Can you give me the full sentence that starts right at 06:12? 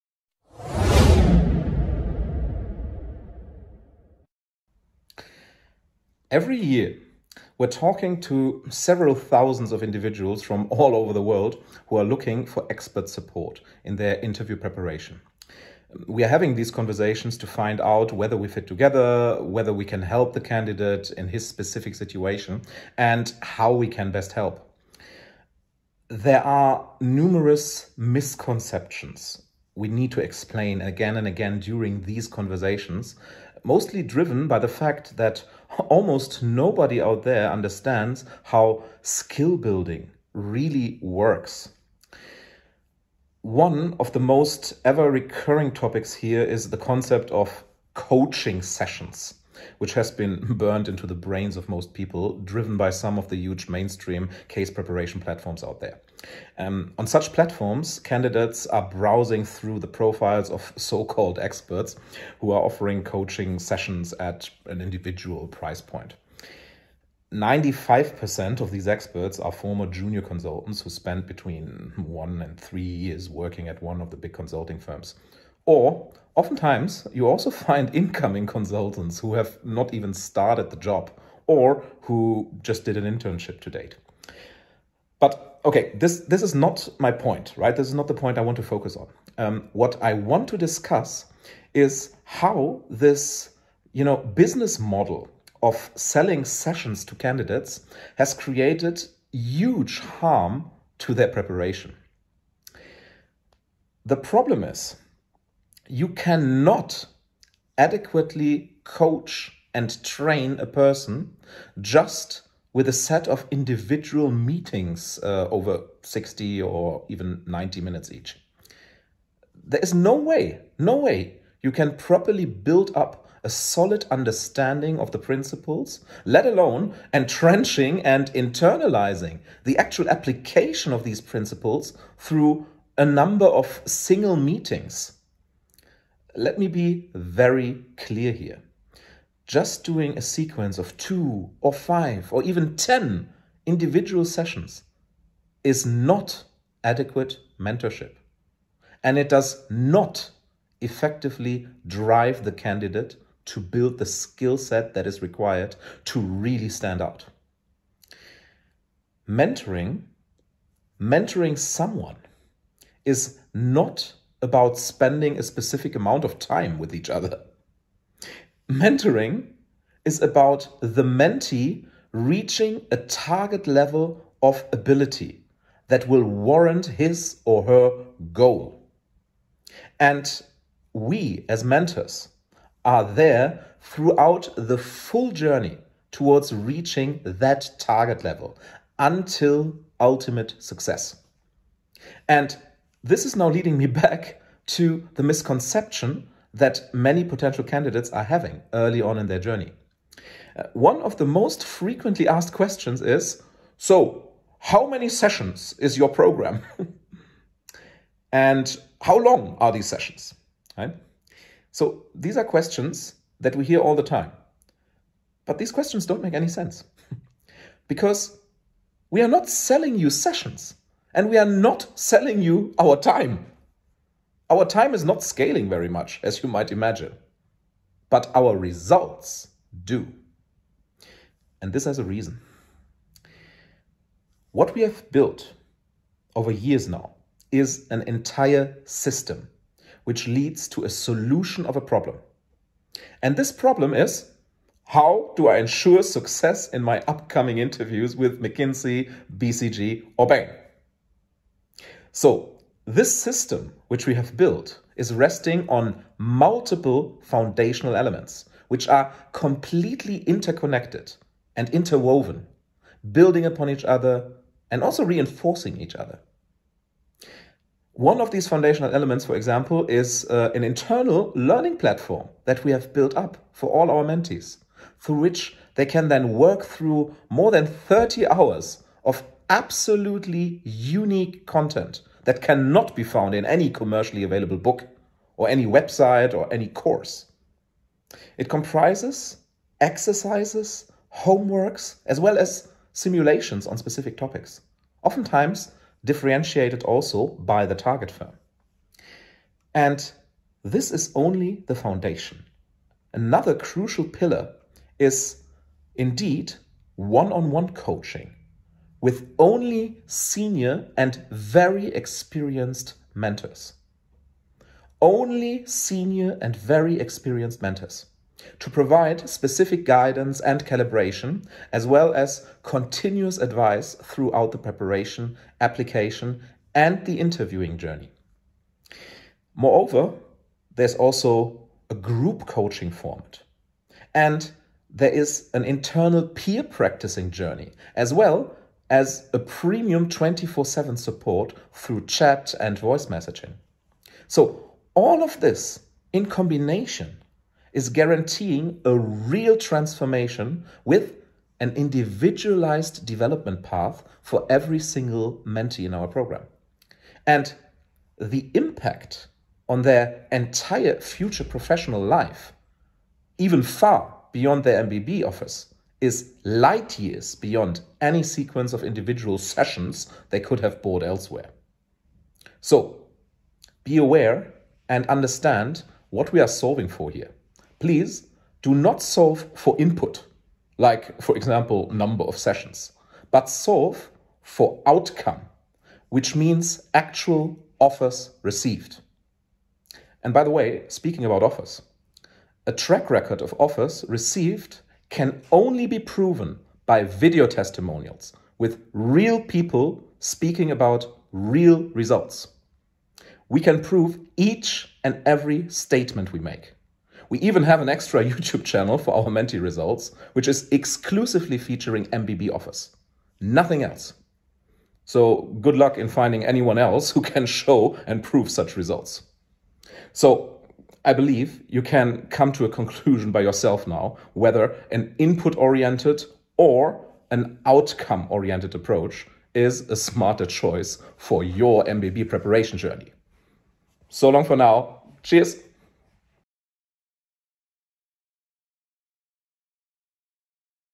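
So, be aware and understand what we are solving for here.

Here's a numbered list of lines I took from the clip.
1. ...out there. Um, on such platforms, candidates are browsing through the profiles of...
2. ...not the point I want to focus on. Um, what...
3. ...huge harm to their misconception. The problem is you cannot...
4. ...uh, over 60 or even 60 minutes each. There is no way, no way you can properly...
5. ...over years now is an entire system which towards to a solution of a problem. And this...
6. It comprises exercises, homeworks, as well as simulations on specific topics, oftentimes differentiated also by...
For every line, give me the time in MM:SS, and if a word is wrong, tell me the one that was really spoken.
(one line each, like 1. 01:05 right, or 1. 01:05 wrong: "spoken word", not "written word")
1. 00:55 right
2. 01:27 right
3. 01:39 wrong: "preparation", not "misconception"
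4. 01:55 wrong: "90", not "60"
5. 03:56 wrong: "leads", not "towards"
6. 04:48 right.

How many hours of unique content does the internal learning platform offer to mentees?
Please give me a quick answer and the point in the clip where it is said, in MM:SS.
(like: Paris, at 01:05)
more than 30 hours, at 04:37.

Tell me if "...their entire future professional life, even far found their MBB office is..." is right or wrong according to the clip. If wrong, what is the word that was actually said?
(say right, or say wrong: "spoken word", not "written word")
wrong: "beyond", not "found".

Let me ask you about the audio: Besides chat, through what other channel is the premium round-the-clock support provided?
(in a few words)
voice messaging.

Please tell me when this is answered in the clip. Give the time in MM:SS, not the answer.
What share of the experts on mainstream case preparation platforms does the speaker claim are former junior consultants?
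01:07.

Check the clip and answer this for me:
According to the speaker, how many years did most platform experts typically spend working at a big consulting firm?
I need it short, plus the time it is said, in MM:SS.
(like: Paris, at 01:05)
1 to 3 years, at 01:11.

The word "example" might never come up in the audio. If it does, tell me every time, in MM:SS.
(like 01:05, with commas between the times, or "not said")
04:29, 06:21.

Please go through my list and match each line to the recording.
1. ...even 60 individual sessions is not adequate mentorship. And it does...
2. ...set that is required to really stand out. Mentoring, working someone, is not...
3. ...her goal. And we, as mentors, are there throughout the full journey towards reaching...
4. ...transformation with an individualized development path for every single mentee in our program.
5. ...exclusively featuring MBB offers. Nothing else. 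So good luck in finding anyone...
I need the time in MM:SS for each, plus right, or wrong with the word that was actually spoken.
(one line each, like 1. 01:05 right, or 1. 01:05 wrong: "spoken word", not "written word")
1. 02:22 wrong: "10", not "60"
2. 02:34 wrong: "mentoring", not "working"
3. 02:57 right
4. 05:49 right
5. 06:50 right.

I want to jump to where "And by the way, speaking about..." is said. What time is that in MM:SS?
06:30.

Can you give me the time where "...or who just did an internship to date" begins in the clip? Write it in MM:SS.
01:21.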